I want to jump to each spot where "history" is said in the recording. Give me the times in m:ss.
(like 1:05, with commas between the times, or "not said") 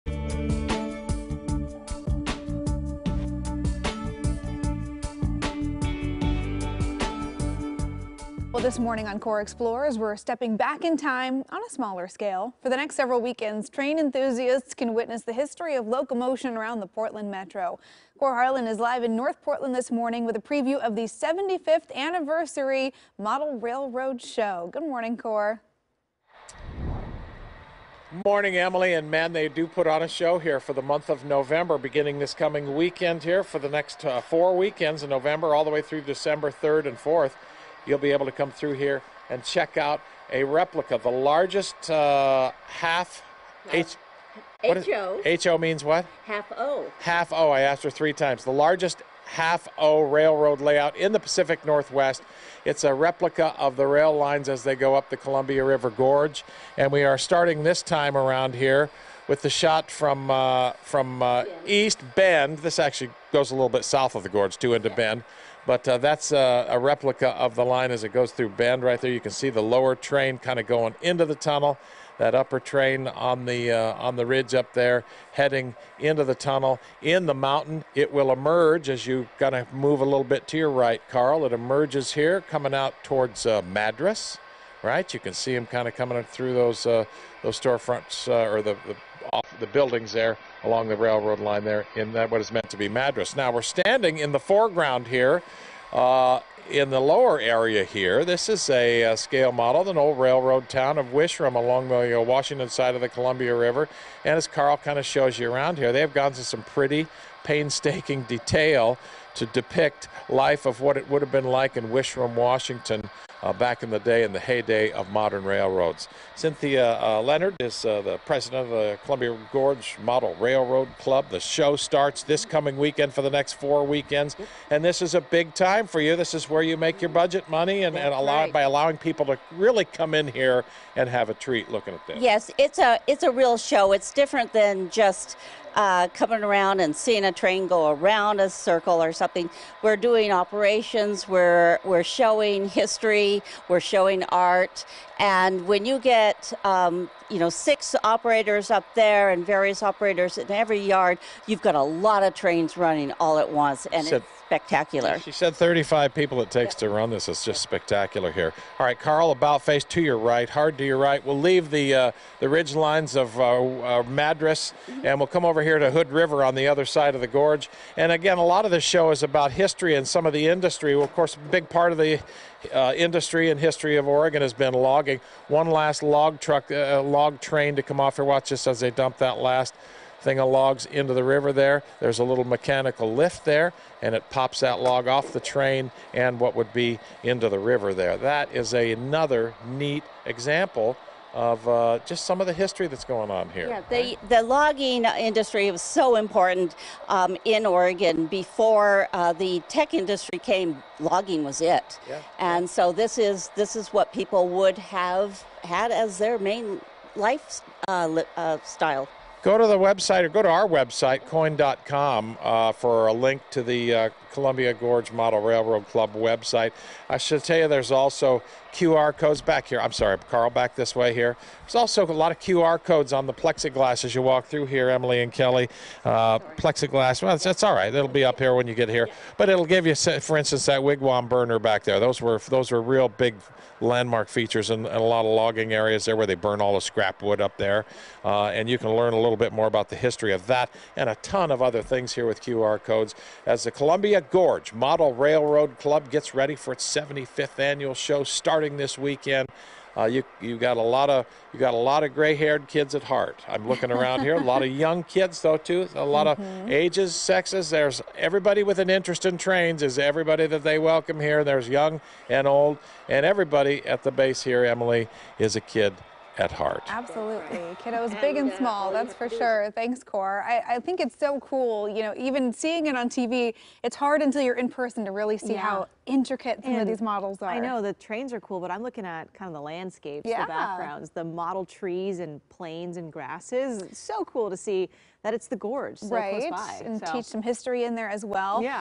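0:15, 2:22, 2:49, 2:53, 3:12, 3:59, 4:47.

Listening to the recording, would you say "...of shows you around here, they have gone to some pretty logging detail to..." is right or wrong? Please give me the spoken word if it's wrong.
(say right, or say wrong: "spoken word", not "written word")
wrong: "painstaking", not "logging".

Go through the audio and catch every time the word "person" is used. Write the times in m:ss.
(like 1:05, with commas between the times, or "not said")
4:34.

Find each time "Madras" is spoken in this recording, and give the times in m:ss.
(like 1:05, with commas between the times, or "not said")
1:23, 1:32, 2:44.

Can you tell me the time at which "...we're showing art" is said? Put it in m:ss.
2:23.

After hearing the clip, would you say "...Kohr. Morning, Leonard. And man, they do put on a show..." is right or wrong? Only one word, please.
wrong.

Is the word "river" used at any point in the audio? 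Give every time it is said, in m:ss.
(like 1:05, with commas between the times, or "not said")
0:55, 1:43, 2:46, 3:01, 3:07.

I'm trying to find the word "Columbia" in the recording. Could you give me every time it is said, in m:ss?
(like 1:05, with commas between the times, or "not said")
0:55, 1:43, 1:59, 3:34, 4:03.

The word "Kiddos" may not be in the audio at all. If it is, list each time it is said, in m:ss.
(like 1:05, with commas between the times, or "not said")
4:27.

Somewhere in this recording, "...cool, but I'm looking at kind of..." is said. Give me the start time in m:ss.
4:38.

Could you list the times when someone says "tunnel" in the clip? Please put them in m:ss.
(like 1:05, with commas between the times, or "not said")
1:11, 1:16.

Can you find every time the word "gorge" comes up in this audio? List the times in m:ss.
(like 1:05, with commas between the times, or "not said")
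0:55, 1:04, 1:59, 2:47, 3:34, 4:04, 4:45.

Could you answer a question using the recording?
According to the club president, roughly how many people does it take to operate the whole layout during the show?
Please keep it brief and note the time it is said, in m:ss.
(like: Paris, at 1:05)
35, at 2:35.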